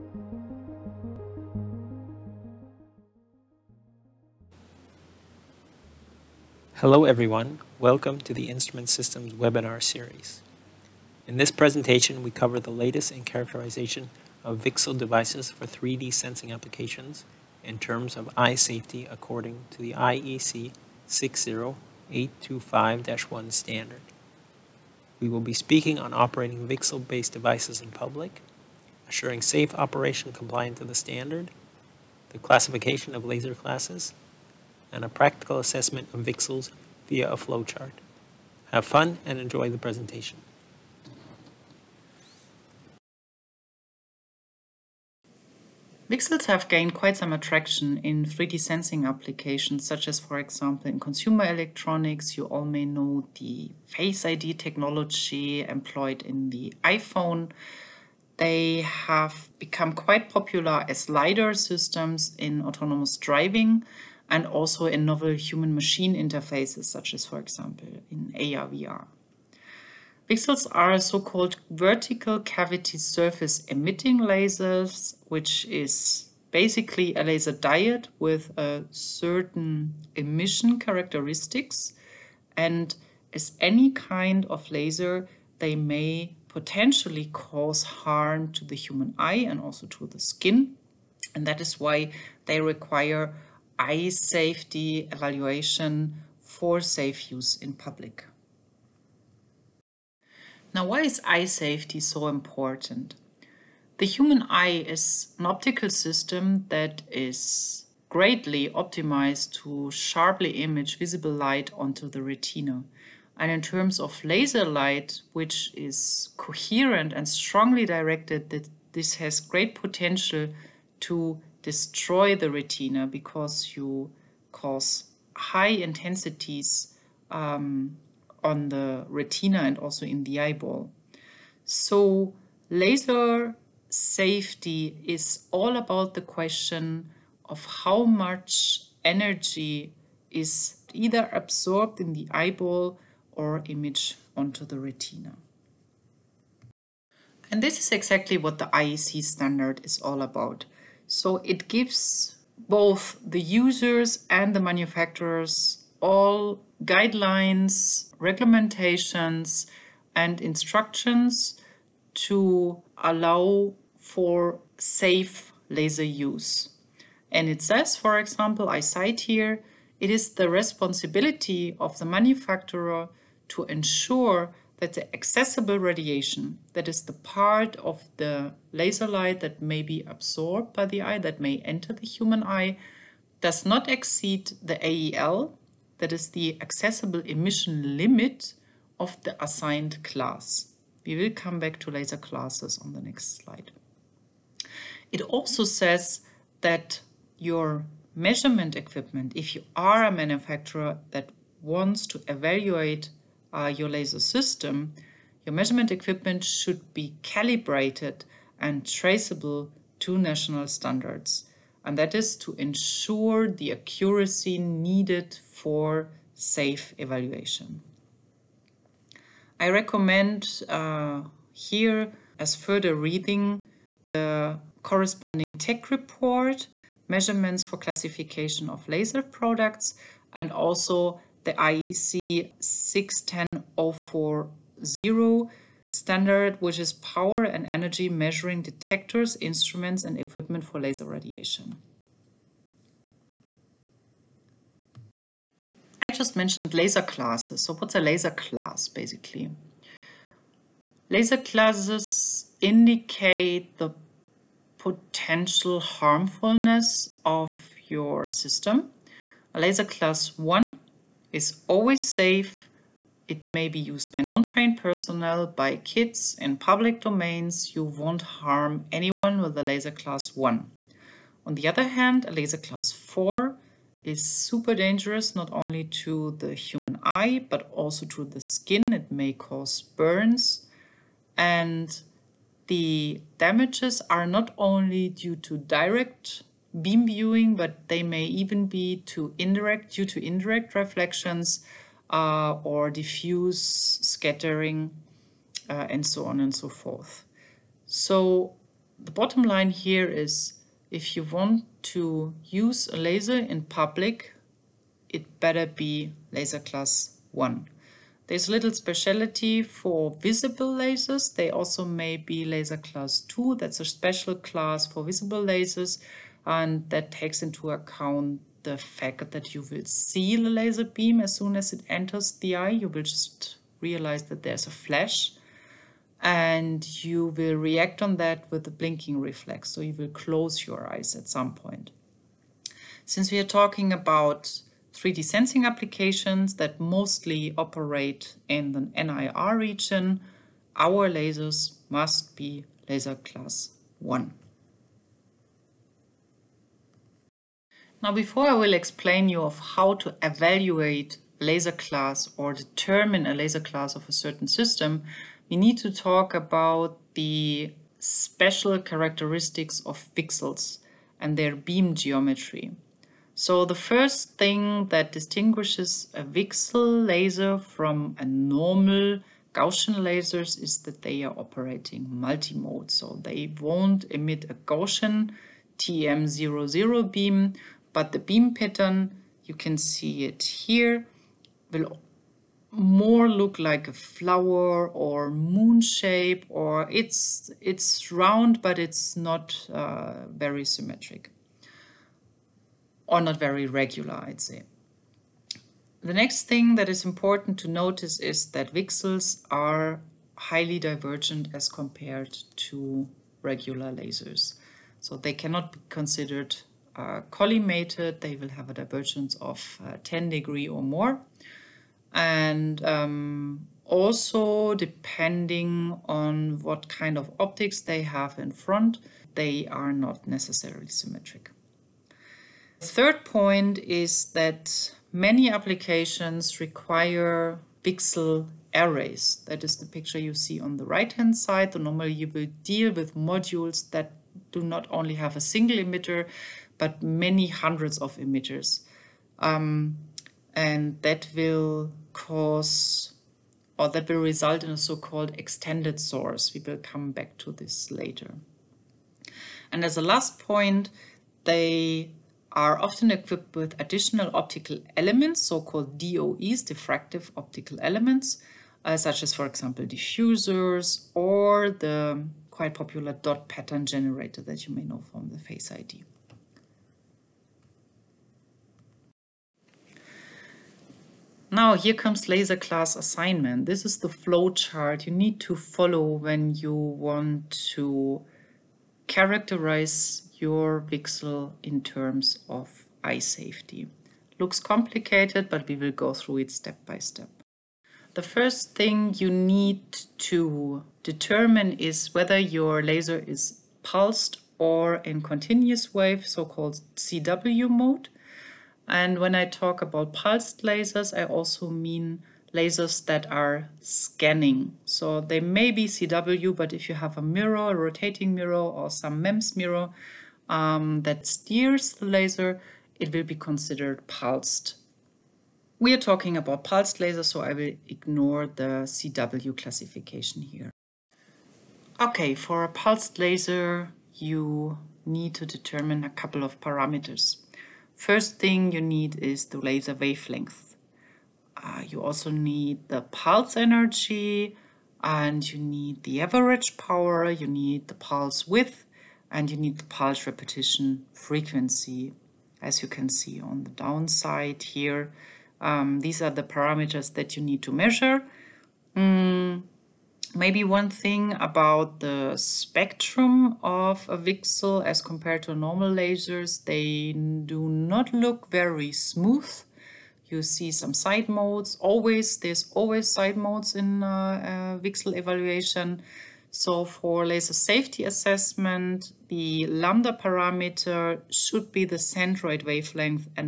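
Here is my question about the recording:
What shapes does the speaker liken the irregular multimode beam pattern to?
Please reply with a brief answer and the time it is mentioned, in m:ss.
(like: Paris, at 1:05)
flower or moon, at 6:23.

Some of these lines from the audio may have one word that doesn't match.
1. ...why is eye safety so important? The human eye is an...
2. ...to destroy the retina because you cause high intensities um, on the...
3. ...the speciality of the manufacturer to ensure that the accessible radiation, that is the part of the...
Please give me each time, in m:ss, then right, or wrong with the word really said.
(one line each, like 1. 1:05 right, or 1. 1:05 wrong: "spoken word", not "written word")
1. 1:40 right
2. 2:01 right
3. 2:50 wrong: "responsibility", not "speciality".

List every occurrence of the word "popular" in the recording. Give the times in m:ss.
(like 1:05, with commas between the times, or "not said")
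1:00, 7:42.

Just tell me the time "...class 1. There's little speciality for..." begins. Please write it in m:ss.
5:06.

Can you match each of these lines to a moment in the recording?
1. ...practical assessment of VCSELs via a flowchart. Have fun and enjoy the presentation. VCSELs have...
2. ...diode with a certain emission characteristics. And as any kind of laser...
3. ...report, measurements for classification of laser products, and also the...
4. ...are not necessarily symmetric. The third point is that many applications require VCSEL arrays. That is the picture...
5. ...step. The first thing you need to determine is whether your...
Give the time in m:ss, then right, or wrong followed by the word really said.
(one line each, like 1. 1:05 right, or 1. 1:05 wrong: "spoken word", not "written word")
1. 0:35 right
2. 1:17 right
3. 3:45 right
4. 6:59 right
5. 8:06 right.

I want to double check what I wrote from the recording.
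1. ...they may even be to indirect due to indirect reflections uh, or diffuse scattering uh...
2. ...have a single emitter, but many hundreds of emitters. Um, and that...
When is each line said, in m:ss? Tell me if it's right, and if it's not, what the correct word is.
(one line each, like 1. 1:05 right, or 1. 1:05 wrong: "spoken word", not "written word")
1. 4:47 right
2. 7:15 right.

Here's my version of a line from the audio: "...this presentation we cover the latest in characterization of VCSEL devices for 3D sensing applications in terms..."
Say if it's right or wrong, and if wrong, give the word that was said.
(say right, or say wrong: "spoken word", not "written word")
right.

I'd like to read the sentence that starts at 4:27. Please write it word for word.
You won't harm anyone with a laser class 1.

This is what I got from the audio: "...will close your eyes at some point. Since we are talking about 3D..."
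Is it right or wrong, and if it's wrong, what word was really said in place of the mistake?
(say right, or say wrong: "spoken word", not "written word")
right.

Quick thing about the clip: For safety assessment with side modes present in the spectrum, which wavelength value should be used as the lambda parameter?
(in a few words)
centroid wavelength.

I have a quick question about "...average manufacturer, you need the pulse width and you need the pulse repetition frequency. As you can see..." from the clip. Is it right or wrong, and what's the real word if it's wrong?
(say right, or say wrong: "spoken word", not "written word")
wrong: "power", not "manufacturer".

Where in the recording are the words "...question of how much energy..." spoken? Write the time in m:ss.
2:16.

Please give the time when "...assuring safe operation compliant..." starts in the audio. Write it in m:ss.
0:29.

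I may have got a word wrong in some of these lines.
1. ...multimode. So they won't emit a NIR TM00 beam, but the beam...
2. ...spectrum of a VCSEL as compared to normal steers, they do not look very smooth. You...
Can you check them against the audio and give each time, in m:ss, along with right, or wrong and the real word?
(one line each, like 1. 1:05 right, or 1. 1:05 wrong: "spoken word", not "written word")
1. 6:12 wrong: "Gaussian", not "NIR"
2. 9:12 wrong: "lasers", not "steers".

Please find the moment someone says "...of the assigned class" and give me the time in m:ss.
3:08.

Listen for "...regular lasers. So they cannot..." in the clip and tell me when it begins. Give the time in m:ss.
6:43.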